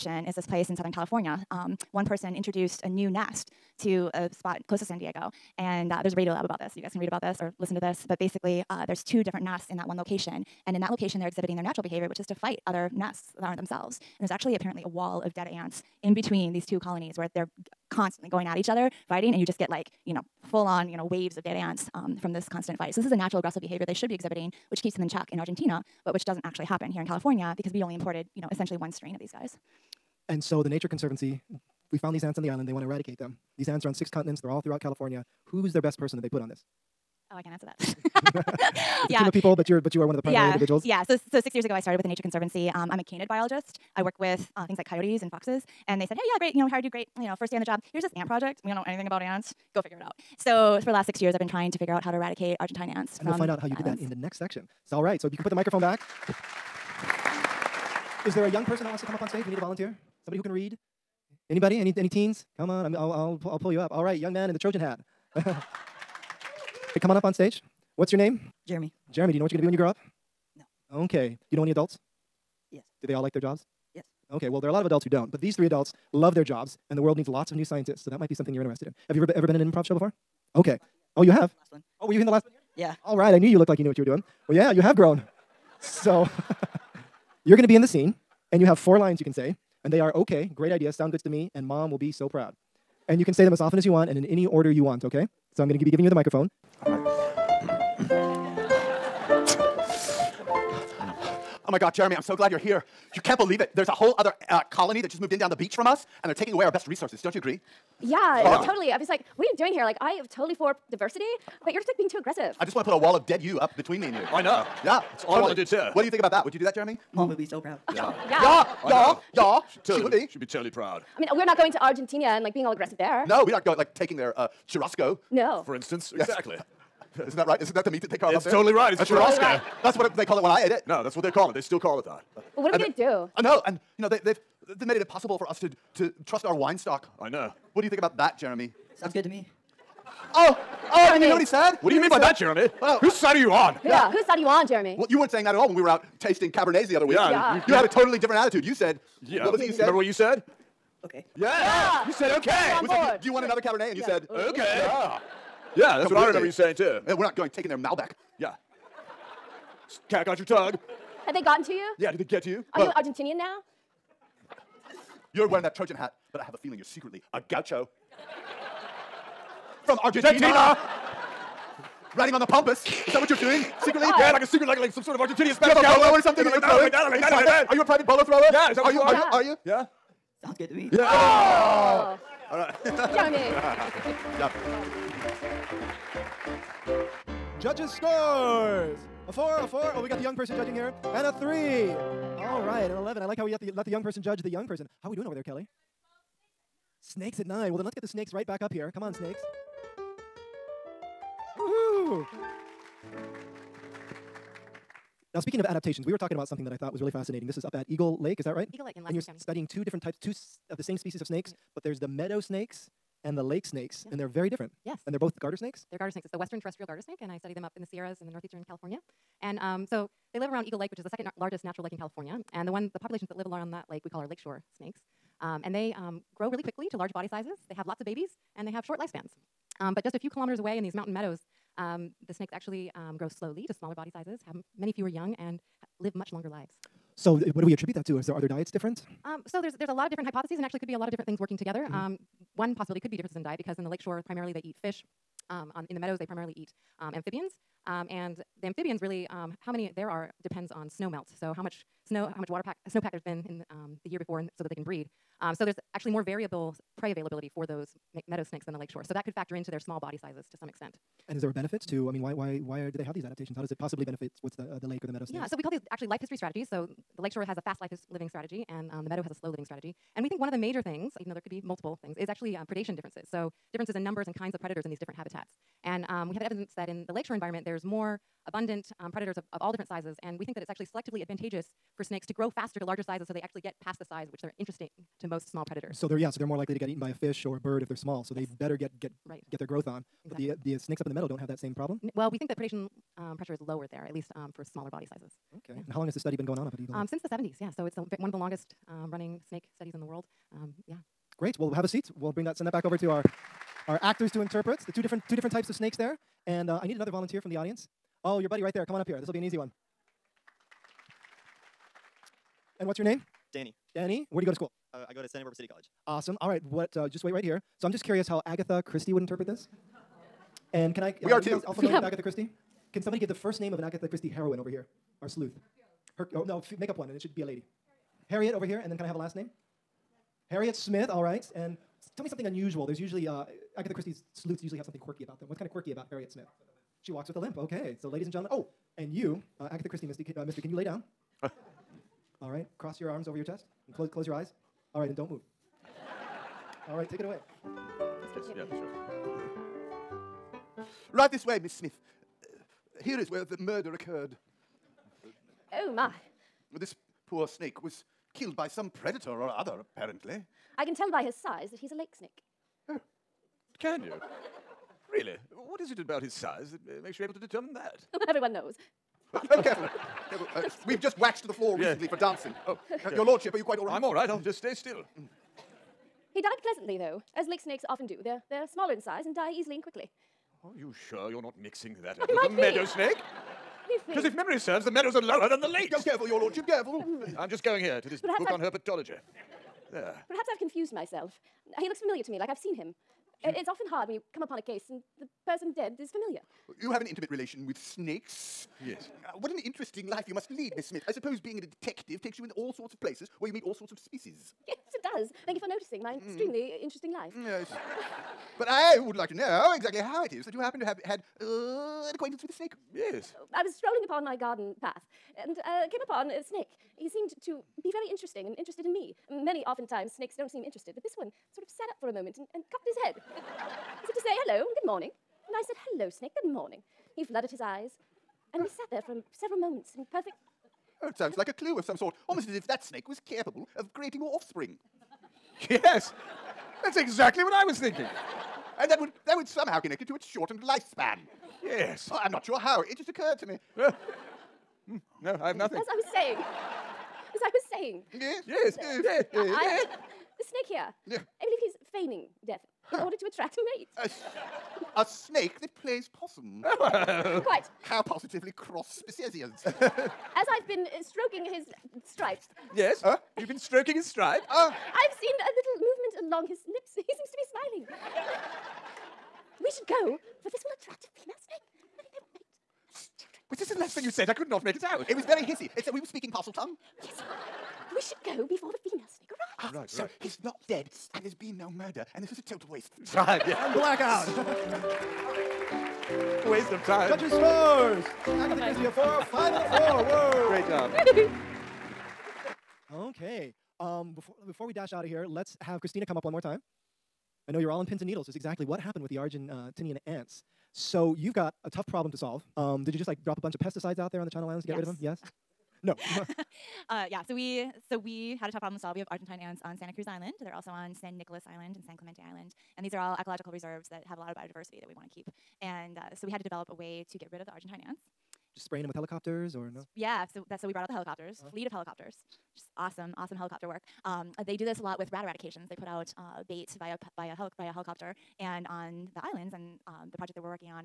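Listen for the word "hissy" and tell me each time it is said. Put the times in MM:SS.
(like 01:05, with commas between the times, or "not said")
07:55.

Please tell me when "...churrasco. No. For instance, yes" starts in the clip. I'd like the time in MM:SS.
02:04.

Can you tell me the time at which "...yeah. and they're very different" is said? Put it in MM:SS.
03:34.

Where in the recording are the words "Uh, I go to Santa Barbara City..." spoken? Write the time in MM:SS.
05:14.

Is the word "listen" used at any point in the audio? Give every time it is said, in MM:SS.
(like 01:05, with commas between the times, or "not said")
00:07.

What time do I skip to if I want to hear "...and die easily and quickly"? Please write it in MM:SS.
06:19.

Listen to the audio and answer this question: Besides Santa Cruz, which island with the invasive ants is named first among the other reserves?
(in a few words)
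San Nicolas Island.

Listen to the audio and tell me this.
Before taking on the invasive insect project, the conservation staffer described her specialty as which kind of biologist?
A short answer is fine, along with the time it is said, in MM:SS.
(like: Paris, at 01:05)
canid biologist, at 00:43.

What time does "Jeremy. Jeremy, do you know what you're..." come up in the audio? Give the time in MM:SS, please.
01:08.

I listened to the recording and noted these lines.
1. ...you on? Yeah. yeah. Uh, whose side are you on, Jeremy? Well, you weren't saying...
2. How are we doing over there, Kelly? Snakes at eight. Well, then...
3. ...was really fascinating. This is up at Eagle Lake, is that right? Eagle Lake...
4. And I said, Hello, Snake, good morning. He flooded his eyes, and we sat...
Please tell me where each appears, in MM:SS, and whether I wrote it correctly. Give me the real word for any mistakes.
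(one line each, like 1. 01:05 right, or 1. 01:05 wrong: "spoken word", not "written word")
1. 02:23 right
2. 03:15 wrong: "nine", not "eight"
3. 03:26 right
4. 07:05 right.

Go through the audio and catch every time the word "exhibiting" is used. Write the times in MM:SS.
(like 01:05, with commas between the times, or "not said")
00:11, 00:24.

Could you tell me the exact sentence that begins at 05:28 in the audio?
Harriet over here, and then can I have a last name?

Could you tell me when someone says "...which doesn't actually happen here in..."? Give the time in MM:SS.
00:26.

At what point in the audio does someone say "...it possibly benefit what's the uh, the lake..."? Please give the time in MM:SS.
04:23.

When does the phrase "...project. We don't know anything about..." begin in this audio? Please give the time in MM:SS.
00:48.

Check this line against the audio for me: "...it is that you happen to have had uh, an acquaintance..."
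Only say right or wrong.
right.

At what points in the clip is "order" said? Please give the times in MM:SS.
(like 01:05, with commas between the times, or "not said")
01:34, 07:33.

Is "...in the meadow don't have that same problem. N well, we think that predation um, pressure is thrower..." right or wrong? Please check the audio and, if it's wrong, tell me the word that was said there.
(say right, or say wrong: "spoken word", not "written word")
wrong: "lower", not "thrower".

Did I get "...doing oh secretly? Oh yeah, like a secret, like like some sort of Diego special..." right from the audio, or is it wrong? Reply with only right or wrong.
wrong.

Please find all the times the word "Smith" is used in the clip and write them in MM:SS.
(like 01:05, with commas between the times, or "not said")
05:30, 05:36, 05:51, 06:40.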